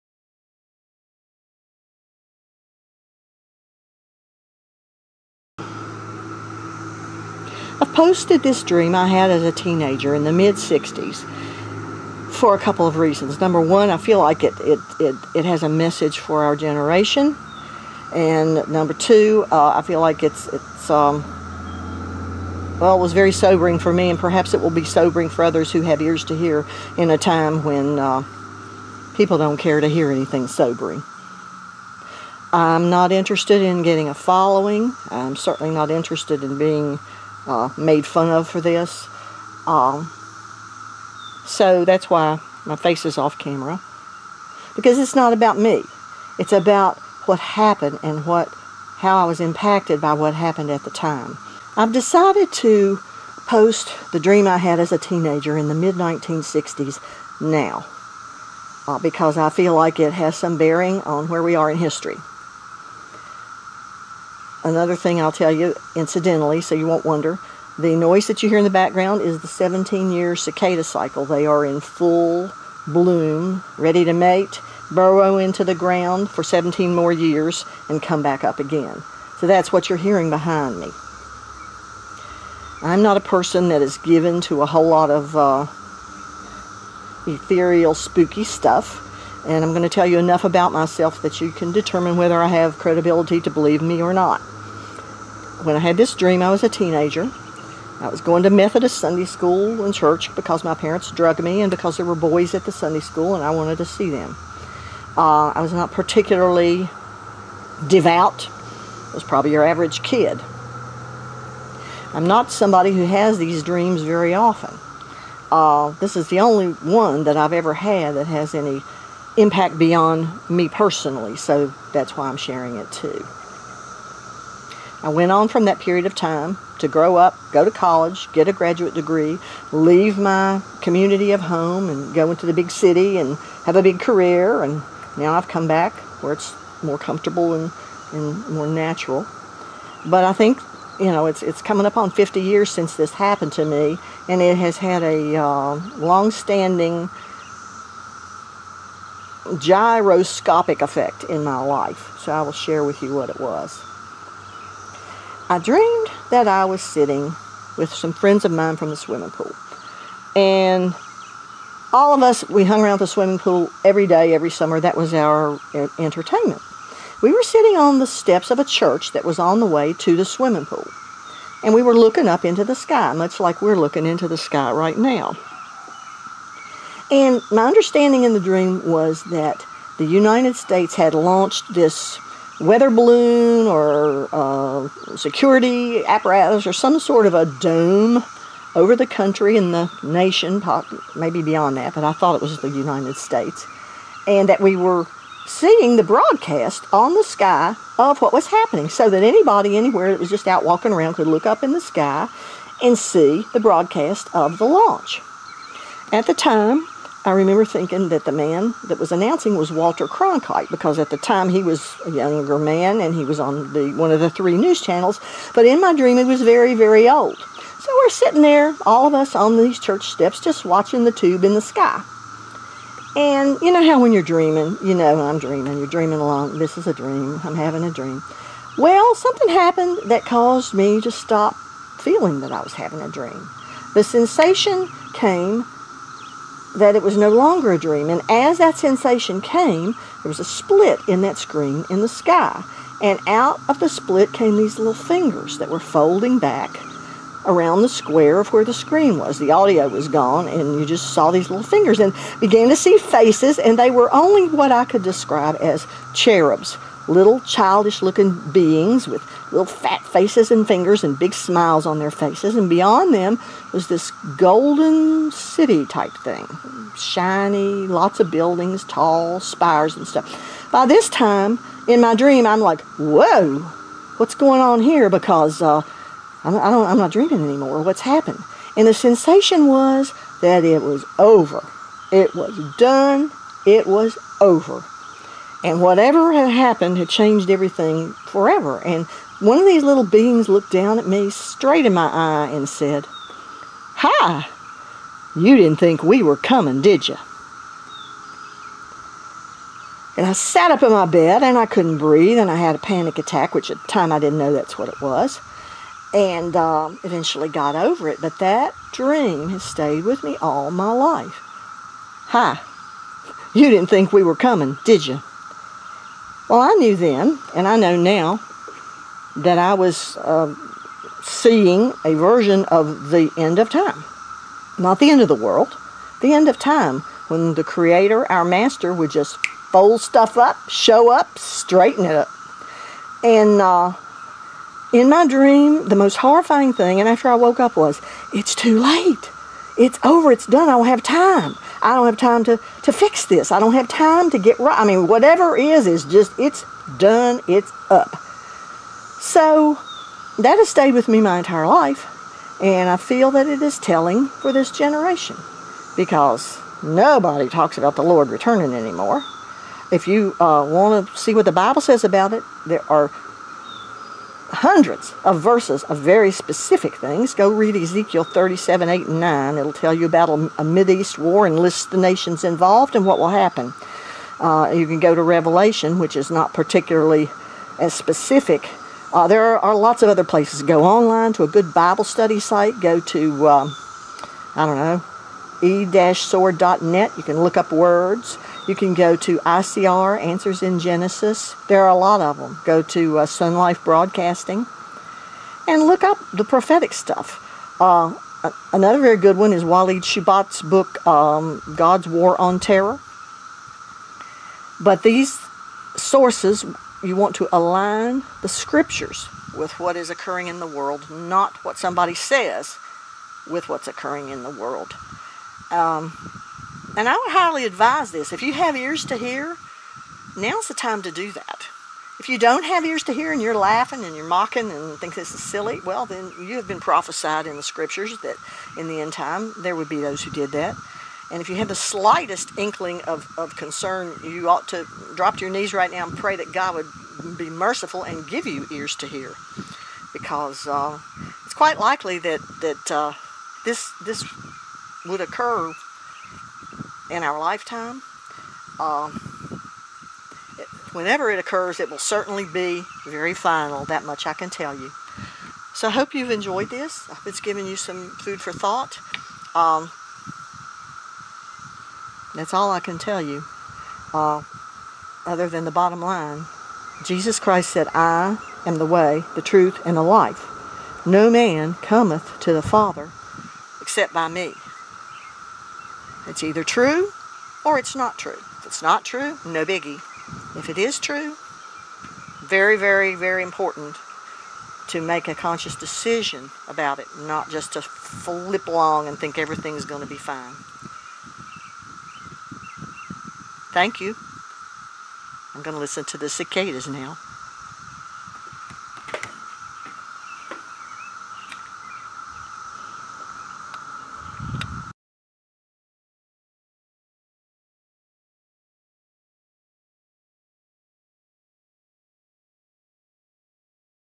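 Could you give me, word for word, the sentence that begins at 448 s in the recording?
Um, whenever it occurs, it will certainly be very final.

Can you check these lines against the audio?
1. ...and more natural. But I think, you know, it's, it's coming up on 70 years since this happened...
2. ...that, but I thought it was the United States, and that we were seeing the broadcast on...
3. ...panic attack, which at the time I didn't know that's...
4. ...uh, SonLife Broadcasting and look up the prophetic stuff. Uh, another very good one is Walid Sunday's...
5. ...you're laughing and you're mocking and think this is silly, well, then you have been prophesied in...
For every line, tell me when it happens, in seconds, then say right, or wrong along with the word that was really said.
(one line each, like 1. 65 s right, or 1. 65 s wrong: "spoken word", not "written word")
1. 138 s wrong: "50", not "70"
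2. 191 s right
3. 302 s right
4. 393 s wrong: "Shoebat", not "Sunday"
5. 423 s right.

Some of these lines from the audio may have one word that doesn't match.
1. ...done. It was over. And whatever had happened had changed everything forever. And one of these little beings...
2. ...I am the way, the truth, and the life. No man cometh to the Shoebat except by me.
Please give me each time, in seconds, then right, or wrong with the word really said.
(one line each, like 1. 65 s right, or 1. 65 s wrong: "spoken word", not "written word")
1. 282 s right
2. 467 s wrong: "Father", not "Shoebat".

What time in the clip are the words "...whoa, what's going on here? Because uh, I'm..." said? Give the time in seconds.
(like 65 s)
272 s.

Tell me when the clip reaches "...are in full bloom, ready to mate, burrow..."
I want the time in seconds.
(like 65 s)
71 s.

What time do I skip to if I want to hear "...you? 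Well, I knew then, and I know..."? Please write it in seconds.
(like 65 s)
315 s.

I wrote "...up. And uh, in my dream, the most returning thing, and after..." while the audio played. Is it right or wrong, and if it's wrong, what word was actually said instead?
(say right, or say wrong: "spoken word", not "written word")
wrong: "horrifying", not "returning".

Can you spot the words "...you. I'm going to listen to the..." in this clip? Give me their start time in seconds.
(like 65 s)
494 s.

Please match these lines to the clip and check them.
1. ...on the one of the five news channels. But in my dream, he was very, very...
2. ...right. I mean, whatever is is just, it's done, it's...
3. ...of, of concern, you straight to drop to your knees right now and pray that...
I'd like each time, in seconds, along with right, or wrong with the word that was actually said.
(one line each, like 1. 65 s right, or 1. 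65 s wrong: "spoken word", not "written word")
1. 213 s wrong: "three", not "five"
2. 344 s right
3. 433 s wrong: "ought", not "straight".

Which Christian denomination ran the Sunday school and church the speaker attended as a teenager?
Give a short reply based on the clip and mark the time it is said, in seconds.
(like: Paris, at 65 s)
Methodist, at 98 s.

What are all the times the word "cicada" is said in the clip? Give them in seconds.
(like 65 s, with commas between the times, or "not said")
70 s, 496 s.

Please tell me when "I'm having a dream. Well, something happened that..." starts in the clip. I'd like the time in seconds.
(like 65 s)
227 s.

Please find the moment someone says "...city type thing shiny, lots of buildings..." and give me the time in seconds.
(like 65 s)
265 s.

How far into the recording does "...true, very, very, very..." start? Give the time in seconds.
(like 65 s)
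480 s.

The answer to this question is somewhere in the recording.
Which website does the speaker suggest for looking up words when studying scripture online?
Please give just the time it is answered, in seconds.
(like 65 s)
385 s.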